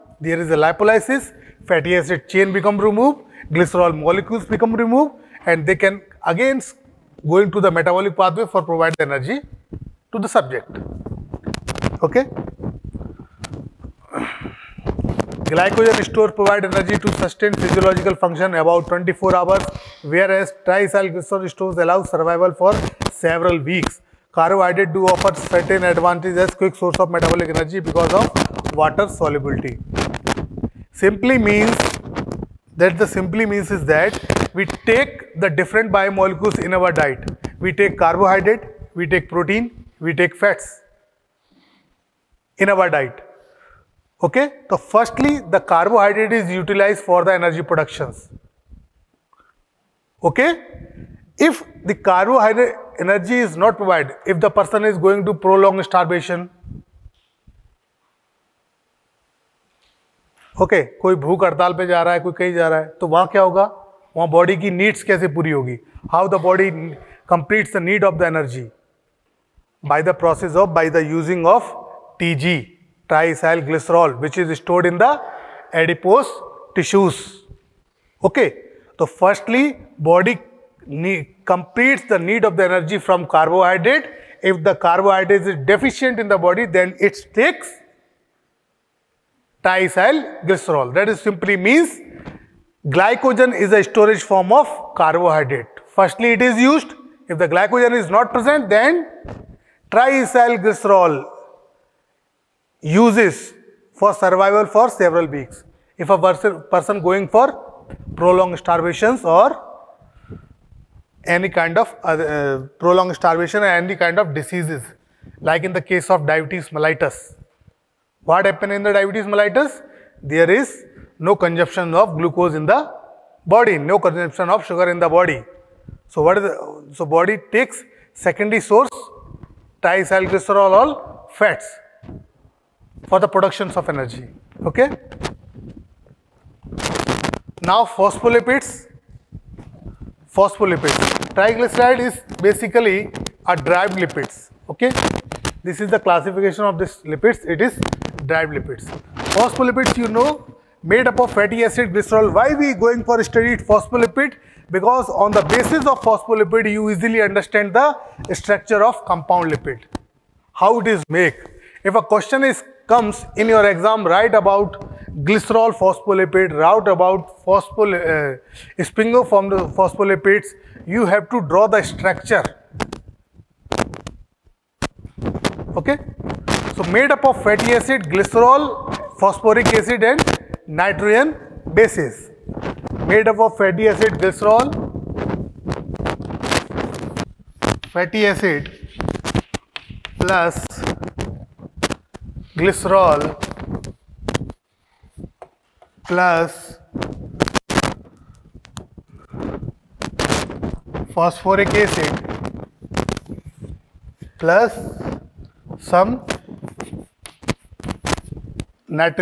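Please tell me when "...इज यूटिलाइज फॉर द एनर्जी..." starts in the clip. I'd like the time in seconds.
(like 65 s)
46 s.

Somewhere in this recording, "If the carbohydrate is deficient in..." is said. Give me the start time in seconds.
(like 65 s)
84 s.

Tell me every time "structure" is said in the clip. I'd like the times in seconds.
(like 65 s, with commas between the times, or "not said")
158 s, 171 s.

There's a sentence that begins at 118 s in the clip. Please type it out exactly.
What happened in the diabetes mellitus?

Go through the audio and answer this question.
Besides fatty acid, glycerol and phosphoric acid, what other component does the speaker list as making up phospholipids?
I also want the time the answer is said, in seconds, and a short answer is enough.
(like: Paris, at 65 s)
Nitrogen bases, at 180 s.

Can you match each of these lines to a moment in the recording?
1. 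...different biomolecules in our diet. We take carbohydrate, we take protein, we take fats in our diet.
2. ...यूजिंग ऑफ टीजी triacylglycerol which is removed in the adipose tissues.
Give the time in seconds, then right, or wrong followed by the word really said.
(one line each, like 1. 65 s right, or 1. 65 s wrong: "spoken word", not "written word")
1. 35 s right
2. 71 s wrong: "stored", not "removed".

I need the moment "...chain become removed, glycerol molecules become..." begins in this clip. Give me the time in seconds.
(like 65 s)
2 s.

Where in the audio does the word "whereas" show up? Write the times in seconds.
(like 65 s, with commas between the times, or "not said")
20 s.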